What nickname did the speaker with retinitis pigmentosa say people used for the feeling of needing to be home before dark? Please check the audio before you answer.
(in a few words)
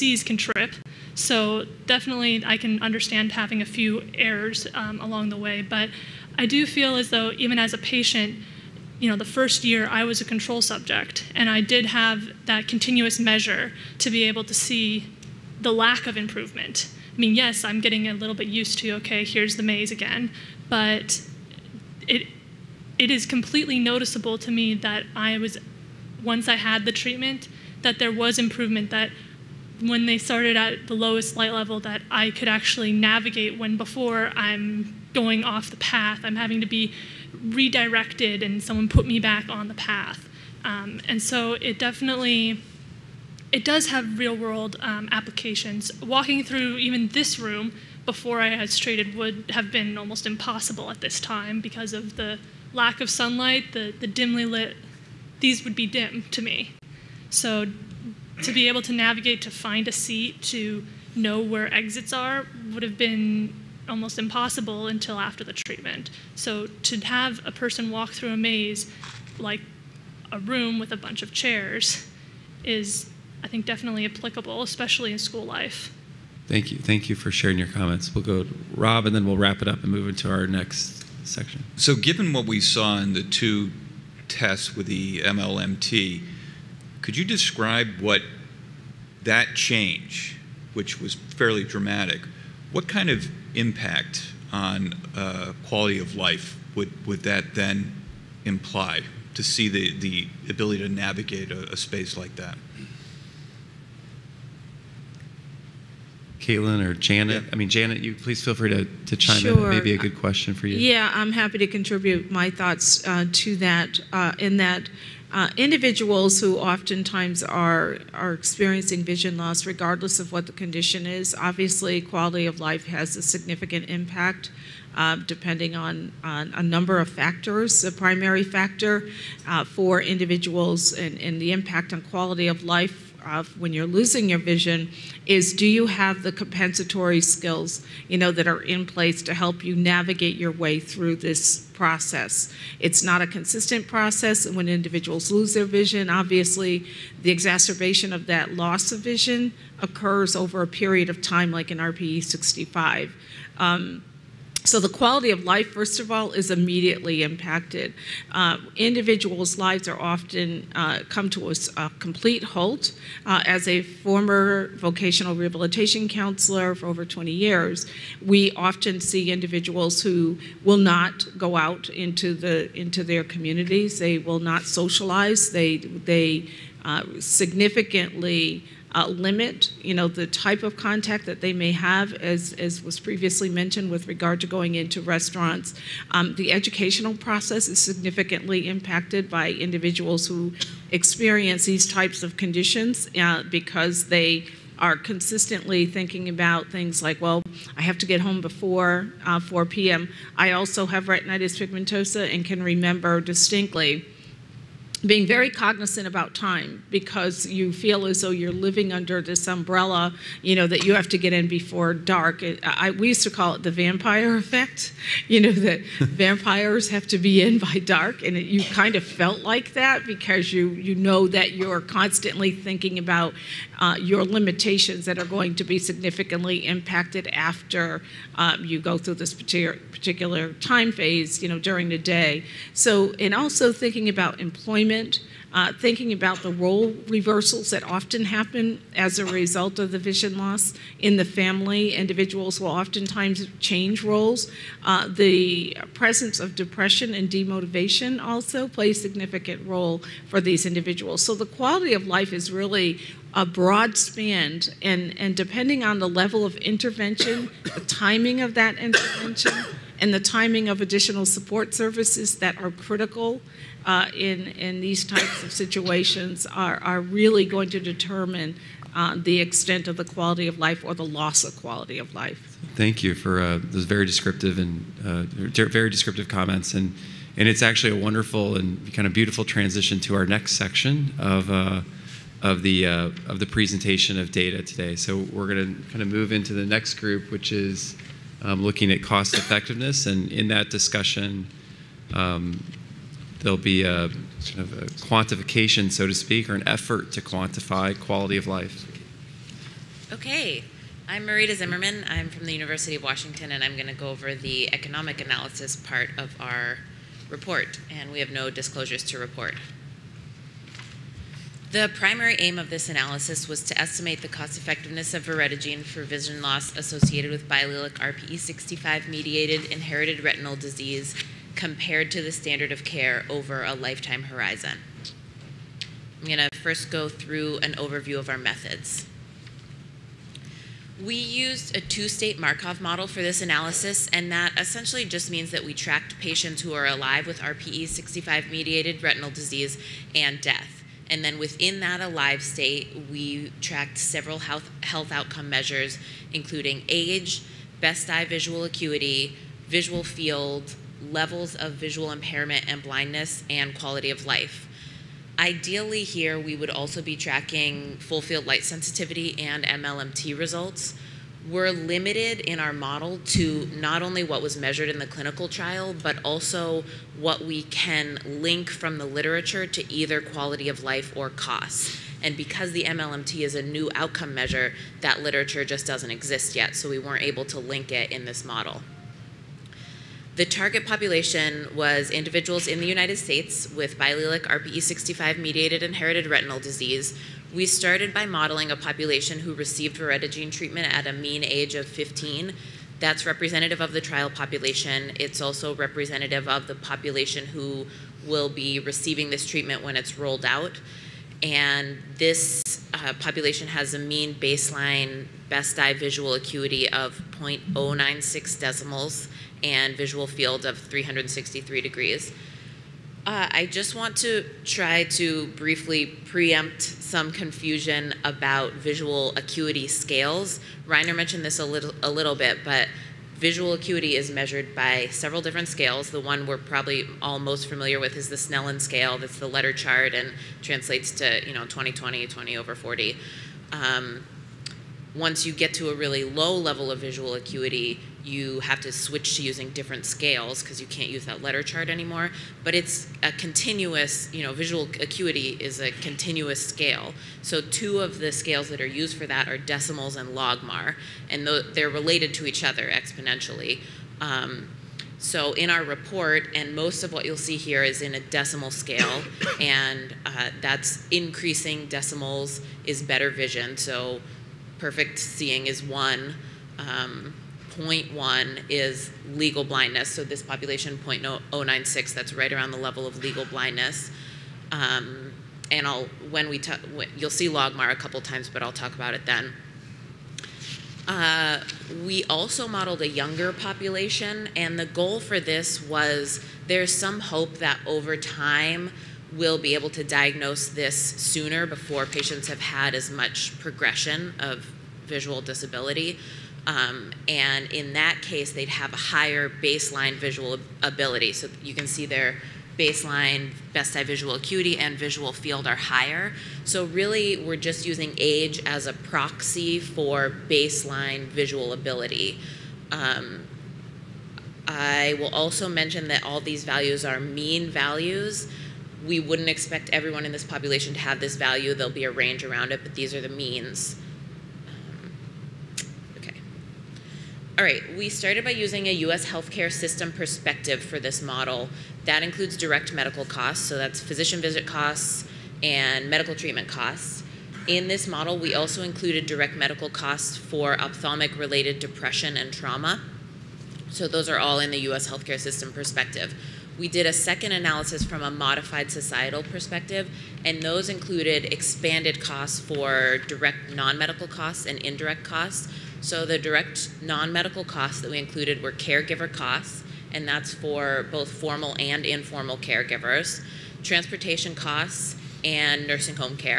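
the vampire effect.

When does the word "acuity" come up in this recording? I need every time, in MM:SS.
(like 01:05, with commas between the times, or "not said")
05:48, 06:46, 06:59, 07:03, 07:17, 07:24, 08:24.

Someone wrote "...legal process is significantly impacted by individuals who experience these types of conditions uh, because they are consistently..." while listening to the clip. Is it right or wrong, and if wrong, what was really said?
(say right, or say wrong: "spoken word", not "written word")
wrong: "educational", not "legal".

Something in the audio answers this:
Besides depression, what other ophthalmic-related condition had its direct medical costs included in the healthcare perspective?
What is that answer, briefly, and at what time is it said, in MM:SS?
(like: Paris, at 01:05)
trauma, at 09:02.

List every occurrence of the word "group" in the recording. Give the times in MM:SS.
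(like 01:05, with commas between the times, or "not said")
04:46.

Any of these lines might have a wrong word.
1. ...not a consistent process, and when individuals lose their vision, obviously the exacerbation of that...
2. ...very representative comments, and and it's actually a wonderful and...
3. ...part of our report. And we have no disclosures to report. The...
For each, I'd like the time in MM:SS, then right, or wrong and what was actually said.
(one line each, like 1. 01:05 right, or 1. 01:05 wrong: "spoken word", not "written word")
1. 02:23 right
2. 04:35 wrong: "descriptive", not "representative"
3. 05:05 right.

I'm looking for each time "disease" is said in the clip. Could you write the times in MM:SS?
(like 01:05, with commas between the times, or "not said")
05:20, 05:39, 06:26.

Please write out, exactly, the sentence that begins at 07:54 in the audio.
Um, and I'll when we talk, you'll see Logmar a couple times, but I'll talk about it then.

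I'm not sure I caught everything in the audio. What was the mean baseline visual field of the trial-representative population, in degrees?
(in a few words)
363 degrees.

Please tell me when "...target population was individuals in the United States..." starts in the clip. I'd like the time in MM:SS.
06:20.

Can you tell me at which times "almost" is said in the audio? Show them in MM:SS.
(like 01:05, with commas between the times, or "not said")
00:49, 01:03.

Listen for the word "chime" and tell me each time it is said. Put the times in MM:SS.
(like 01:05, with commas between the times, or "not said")
01:49.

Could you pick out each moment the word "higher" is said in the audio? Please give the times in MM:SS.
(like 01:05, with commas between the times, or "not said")
08:18, 08:25.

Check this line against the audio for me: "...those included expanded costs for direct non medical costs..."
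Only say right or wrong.
right.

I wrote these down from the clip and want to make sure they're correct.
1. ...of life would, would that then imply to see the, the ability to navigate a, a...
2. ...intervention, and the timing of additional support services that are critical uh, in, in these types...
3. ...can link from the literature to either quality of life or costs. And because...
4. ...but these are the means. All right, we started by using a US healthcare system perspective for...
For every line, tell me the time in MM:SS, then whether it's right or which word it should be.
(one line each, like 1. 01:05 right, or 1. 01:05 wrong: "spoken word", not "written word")
1. 01:35 right
2. 04:18 right
3. 06:07 right
4. 08:42 right.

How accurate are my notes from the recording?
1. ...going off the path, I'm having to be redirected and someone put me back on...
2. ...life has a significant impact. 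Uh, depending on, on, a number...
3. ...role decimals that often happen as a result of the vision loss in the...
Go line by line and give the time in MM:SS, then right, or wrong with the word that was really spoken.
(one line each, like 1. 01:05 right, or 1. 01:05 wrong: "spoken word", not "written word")
1. 00:35 right
2. 02:02 right
3. 03:56 wrong: "reversals", not "decimals".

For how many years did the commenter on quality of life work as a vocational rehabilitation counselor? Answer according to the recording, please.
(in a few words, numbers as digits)
over 20 years.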